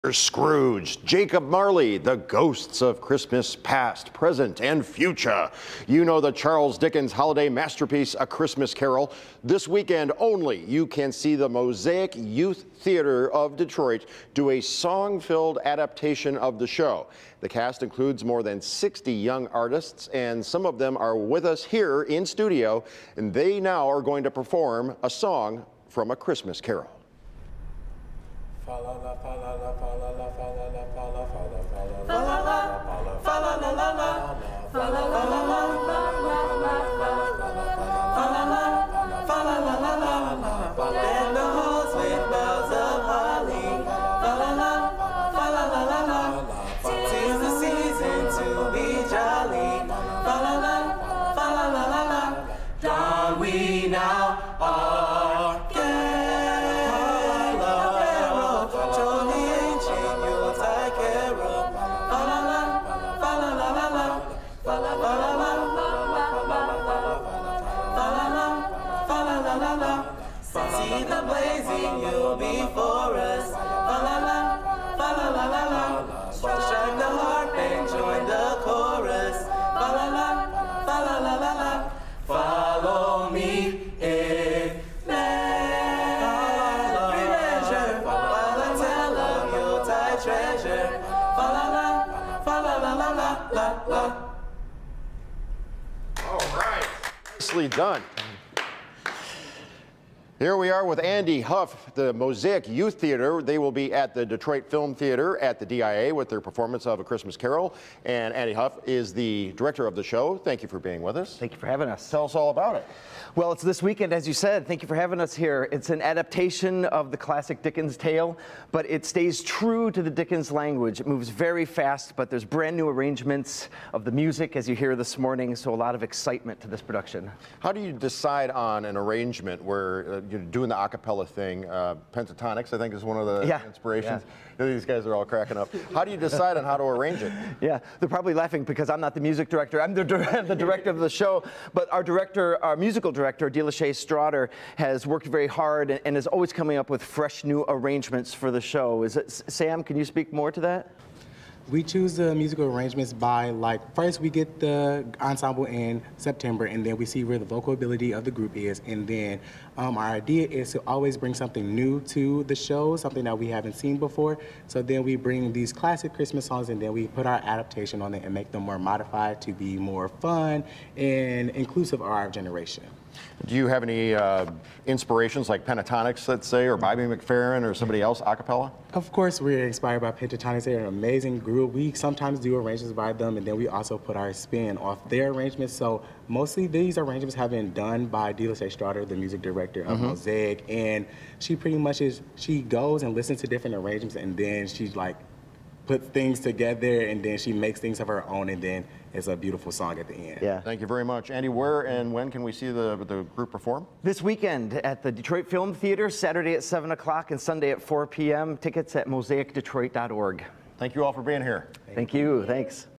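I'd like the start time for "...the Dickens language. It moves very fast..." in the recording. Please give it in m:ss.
2:00.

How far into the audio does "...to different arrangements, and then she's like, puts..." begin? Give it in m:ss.
3:13.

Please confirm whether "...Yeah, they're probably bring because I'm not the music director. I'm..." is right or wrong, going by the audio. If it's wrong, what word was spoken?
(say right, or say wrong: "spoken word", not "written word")
wrong: "laughing", not "bring".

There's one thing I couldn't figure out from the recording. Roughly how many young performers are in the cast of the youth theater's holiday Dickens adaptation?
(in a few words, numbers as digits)
more than 60.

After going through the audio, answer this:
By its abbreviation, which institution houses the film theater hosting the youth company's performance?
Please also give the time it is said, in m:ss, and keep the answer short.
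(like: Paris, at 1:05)
DIA, at 1:45.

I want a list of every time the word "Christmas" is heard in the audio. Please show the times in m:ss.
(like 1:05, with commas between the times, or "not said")
0:03, 0:08, 0:26, 1:47, 2:46.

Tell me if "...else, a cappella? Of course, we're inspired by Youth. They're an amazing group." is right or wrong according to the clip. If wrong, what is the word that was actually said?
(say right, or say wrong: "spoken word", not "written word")
wrong: "Pentatonix", not "Youth".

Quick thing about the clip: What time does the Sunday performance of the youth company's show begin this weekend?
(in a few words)
4 p.m.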